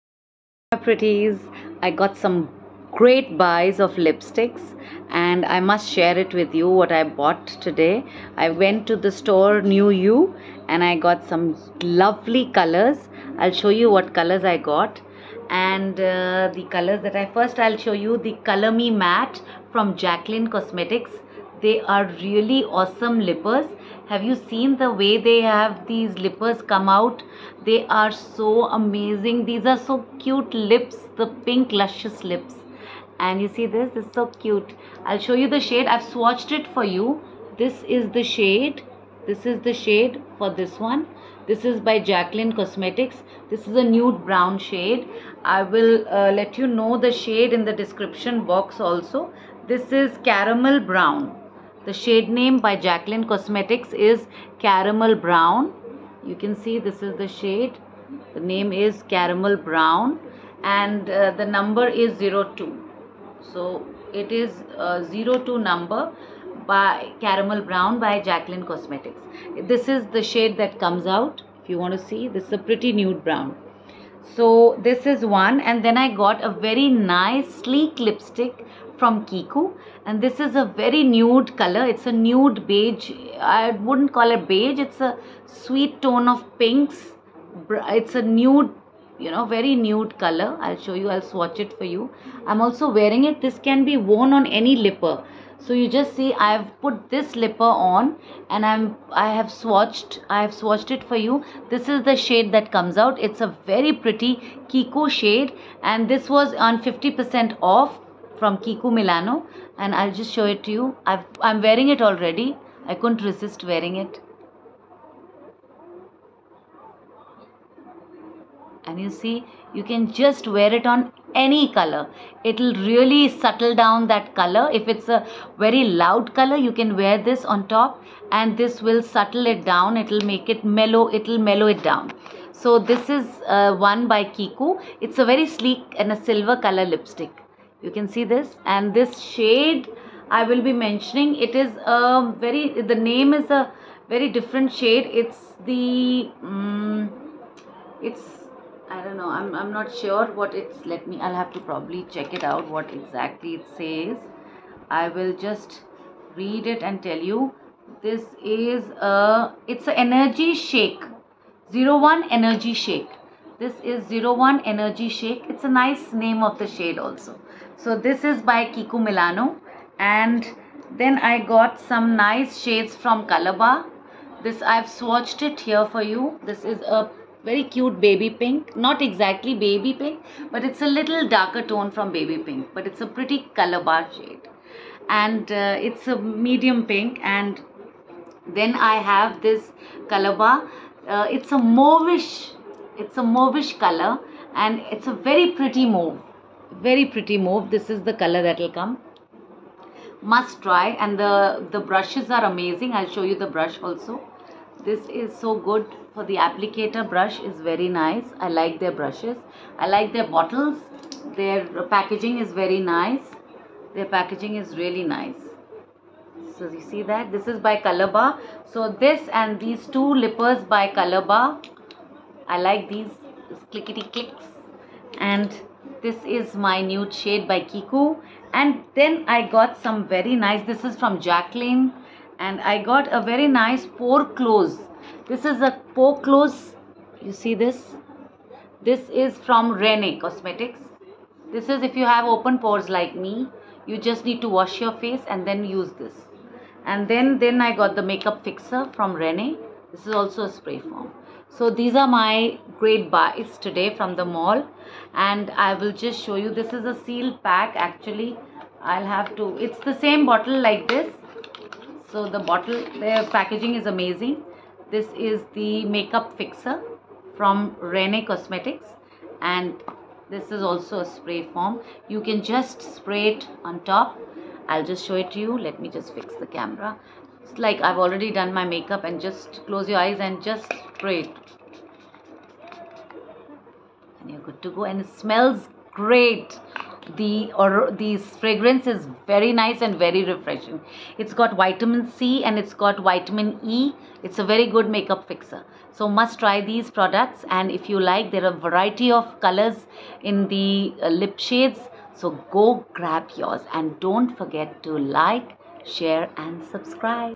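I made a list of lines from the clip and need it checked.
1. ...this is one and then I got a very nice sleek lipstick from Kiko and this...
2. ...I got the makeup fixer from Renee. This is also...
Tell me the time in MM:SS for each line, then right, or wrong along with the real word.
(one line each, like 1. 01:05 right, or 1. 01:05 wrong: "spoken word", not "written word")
1. 01:14 right
2. 04:07 right.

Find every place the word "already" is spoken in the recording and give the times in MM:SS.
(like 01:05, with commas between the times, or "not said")
01:52, 04:38.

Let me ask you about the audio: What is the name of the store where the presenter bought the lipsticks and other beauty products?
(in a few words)
New U.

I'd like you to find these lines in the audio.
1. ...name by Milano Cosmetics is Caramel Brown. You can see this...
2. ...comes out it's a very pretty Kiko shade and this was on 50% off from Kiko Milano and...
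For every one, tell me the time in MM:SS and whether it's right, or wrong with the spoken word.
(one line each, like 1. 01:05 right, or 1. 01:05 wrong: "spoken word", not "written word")
1. 00:52 wrong: "Jacqueline", not "Milano"
2. 01:42 right.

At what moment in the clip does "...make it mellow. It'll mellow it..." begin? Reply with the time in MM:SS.
02:10.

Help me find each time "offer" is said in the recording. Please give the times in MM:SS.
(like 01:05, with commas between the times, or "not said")
not said.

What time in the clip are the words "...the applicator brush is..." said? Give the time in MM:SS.
03:26.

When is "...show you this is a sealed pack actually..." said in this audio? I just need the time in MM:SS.
04:16.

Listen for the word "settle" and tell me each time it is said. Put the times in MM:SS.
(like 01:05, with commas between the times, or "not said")
02:03, 02:09.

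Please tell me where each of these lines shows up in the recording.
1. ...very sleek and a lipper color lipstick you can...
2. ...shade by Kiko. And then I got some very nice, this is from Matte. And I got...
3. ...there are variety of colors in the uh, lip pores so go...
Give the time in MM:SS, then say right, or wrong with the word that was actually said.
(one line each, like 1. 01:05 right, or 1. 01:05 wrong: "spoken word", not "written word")
1. 02:15 wrong: "silver", not "lipper"
2. 03:47 wrong: "Jacqueline", not "Matte"
3. 04:58 wrong: "shades", not "pores".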